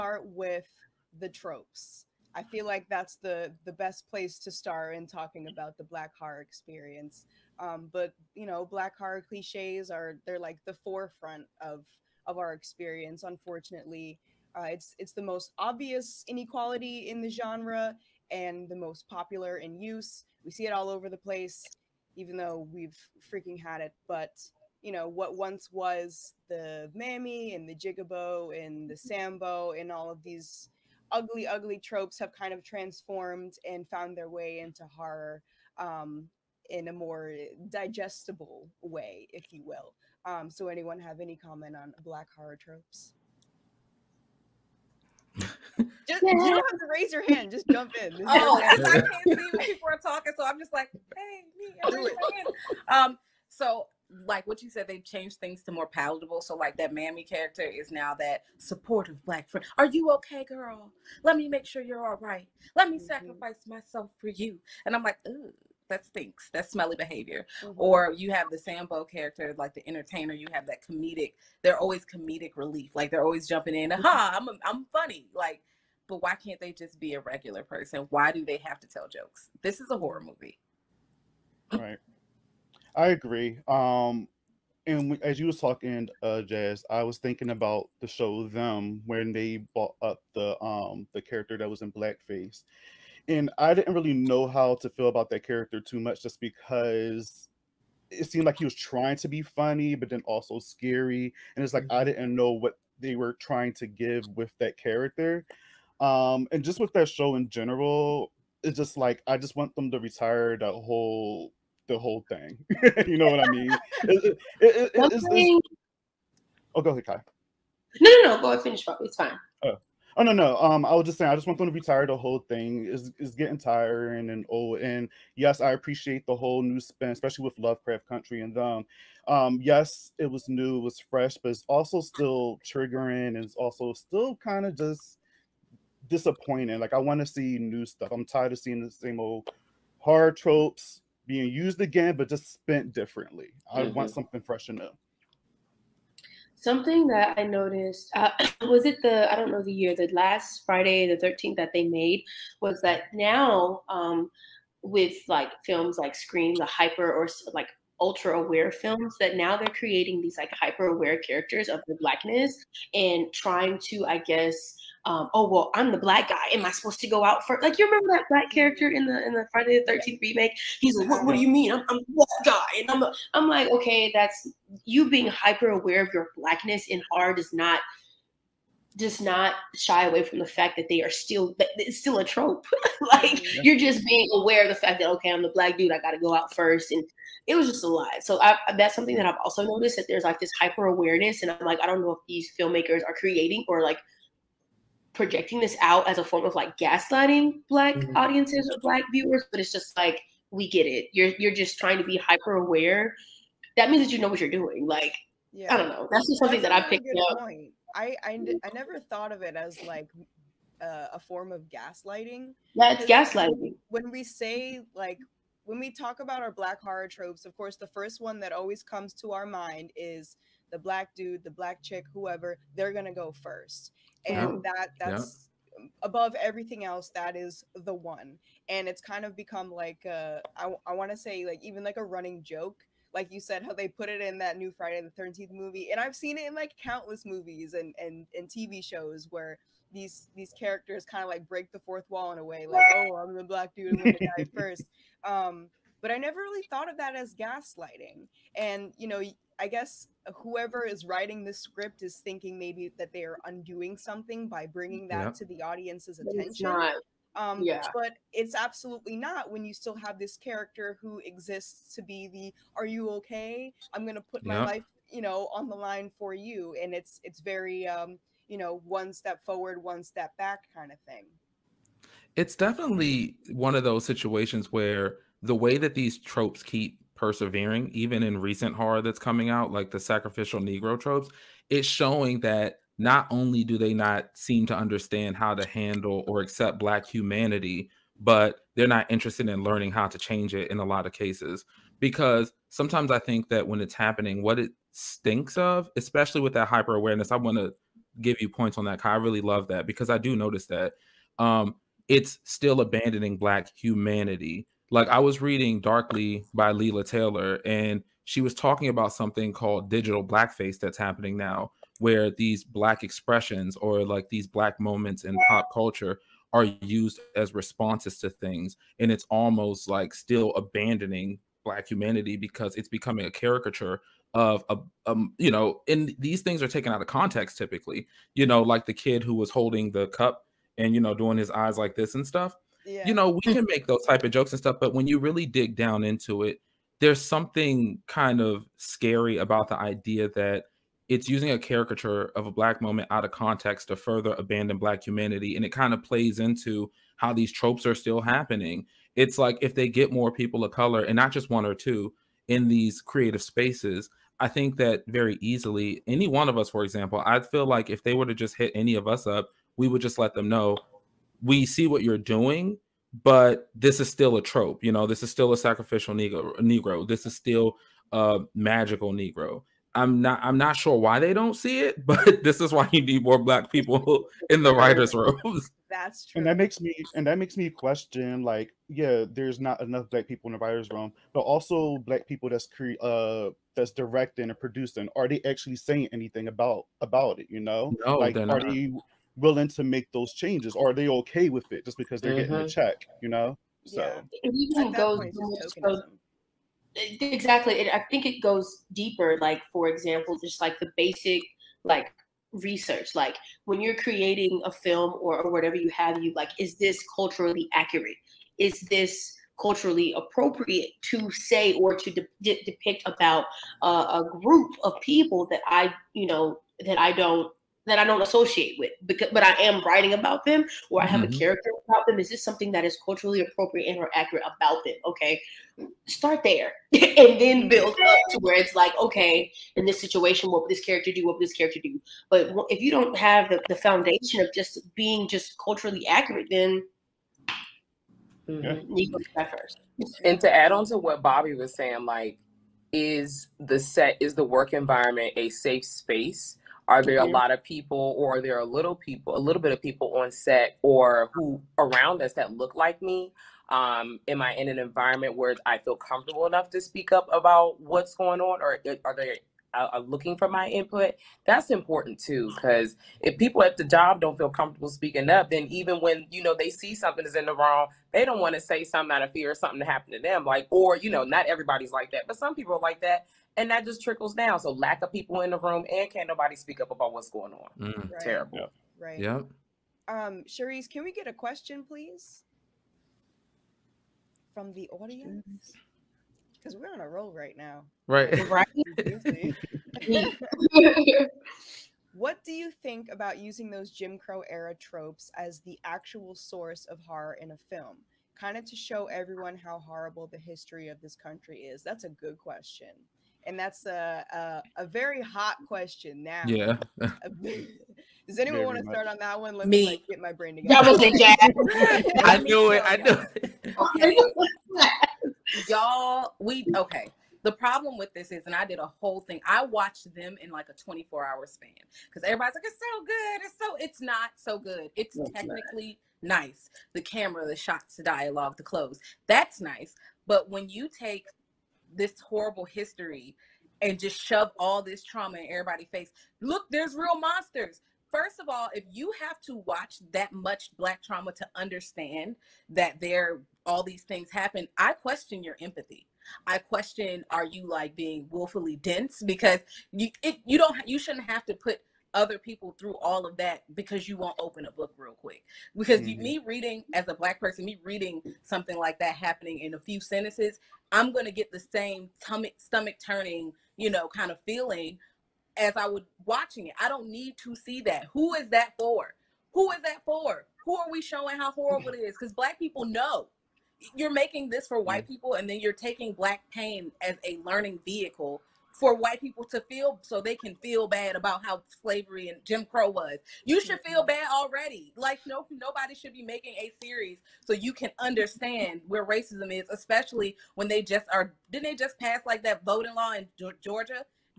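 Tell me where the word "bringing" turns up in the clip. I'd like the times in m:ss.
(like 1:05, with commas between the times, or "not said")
4:14.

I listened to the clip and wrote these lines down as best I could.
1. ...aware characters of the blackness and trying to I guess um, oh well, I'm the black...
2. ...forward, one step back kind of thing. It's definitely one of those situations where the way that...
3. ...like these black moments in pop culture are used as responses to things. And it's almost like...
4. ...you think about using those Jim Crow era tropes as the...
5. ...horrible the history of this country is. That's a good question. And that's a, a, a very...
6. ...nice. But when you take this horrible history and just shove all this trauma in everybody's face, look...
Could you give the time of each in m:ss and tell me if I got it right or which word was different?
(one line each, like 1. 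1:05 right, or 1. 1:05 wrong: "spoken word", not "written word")
1. 2:40 right
2. 4:29 right
3. 5:14 right
4. 8:12 right
5. 8:19 right
6. 8:49 right.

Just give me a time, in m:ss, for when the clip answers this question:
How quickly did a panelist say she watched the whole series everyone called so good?
8:40.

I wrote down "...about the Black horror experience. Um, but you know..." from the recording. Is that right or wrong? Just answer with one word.
right.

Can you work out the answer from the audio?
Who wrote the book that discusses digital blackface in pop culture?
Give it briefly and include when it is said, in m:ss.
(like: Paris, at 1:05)
Leila Taylor, at 5:06.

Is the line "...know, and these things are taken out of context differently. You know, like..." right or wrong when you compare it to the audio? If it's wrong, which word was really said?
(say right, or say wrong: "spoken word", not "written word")
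wrong: "typically", not "differently".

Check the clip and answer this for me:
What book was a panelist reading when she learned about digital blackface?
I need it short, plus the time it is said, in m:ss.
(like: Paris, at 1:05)
Darkly, at 5:05.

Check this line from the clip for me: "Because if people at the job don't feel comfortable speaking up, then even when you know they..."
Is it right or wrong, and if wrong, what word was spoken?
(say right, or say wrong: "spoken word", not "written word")
right.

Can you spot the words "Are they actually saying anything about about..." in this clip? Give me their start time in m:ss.
6:25.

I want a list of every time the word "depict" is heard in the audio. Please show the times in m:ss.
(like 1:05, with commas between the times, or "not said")
6:52.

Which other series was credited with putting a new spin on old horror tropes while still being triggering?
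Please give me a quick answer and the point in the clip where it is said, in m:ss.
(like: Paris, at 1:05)
Lovecraft Country, at 2:07.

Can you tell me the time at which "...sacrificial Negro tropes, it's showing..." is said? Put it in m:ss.
4:39.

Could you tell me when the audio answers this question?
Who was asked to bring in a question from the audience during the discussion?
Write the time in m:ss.
8:00.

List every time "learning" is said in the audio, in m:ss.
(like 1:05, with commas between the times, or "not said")
4:49, 9:37.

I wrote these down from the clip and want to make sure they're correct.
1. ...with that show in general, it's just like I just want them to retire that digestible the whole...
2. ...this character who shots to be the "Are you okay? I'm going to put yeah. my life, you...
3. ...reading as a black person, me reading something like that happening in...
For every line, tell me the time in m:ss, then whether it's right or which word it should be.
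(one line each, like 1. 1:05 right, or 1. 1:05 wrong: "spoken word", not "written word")
1. 1:46 wrong: "whole", not "digestible"
2. 4:20 wrong: "exists", not "shots"
3. 9:16 right.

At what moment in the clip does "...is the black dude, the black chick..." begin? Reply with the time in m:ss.
3:39.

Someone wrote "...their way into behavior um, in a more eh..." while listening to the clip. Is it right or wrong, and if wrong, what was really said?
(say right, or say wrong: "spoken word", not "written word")
wrong: "horror", not "behavior".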